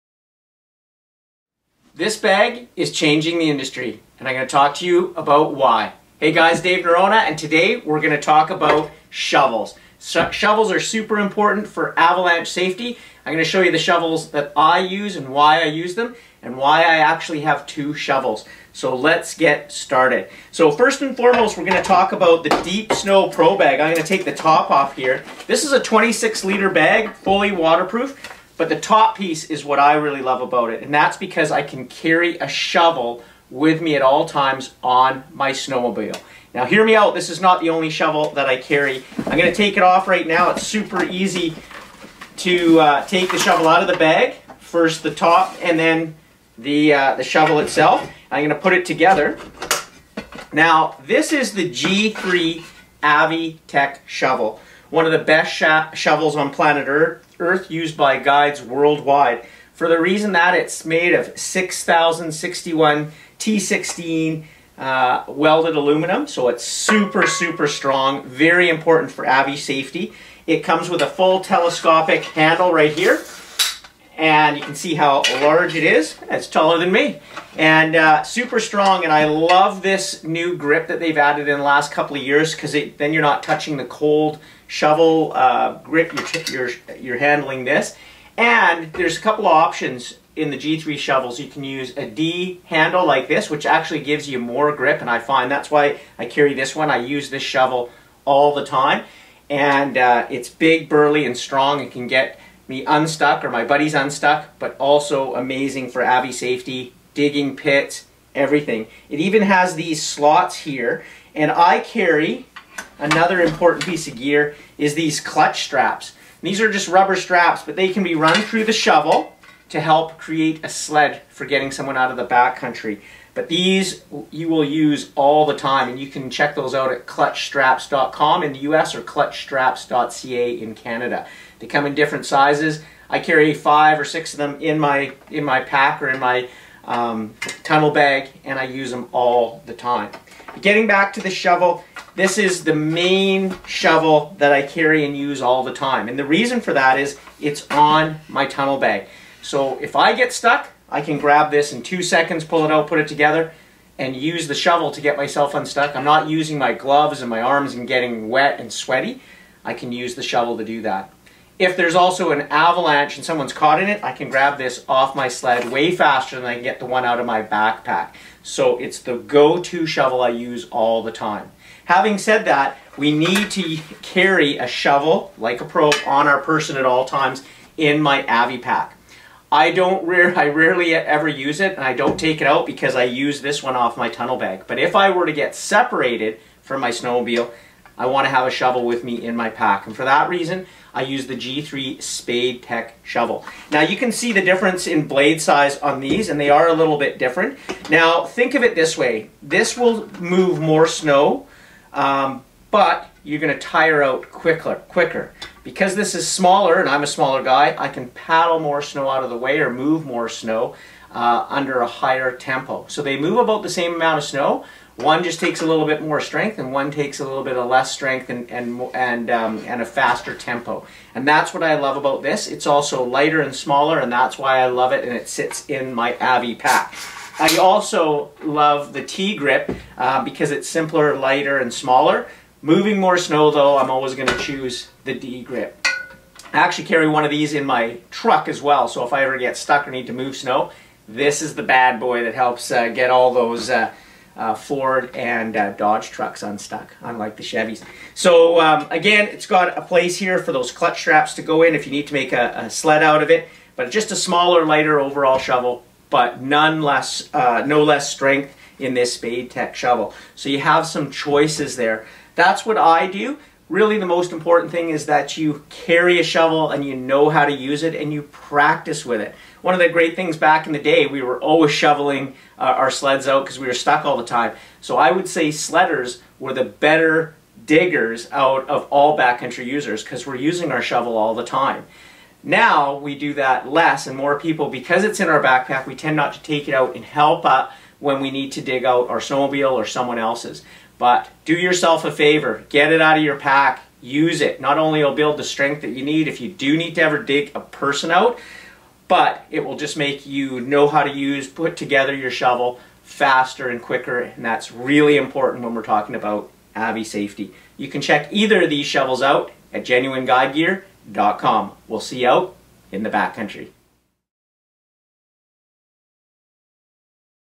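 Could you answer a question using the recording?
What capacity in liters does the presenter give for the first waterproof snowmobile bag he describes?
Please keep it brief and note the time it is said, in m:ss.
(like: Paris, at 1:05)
26 liters, at 0:25.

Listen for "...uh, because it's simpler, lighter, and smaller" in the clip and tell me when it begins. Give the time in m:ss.
3:49.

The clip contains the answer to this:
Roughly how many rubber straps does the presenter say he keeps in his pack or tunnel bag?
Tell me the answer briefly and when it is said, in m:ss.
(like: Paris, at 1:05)
5 or 6, at 2:13.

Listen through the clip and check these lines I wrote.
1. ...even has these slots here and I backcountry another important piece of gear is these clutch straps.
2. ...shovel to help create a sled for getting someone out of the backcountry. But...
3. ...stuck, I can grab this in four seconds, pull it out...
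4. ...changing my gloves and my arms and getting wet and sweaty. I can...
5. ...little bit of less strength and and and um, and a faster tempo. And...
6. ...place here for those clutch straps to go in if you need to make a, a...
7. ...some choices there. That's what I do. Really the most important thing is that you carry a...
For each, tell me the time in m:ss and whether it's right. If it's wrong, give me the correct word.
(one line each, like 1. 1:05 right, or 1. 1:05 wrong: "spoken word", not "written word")
1. 1:49 wrong: "carry", not "backcountry"
2. 1:58 right
3. 2:30 wrong: "two", not "four"
4. 2:36 wrong: "using", not "changing"
5. 3:37 right
6. 4:09 right
7. 4:20 right.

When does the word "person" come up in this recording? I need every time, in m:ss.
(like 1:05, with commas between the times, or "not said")
2:56, 4:57.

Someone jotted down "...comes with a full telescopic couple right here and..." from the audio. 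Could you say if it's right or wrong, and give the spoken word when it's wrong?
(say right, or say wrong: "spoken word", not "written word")
wrong: "handle", not "couple".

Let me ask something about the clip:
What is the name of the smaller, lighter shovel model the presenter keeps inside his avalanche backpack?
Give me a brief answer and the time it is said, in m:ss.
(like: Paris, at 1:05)
G3 Spade Tech, at 3:11.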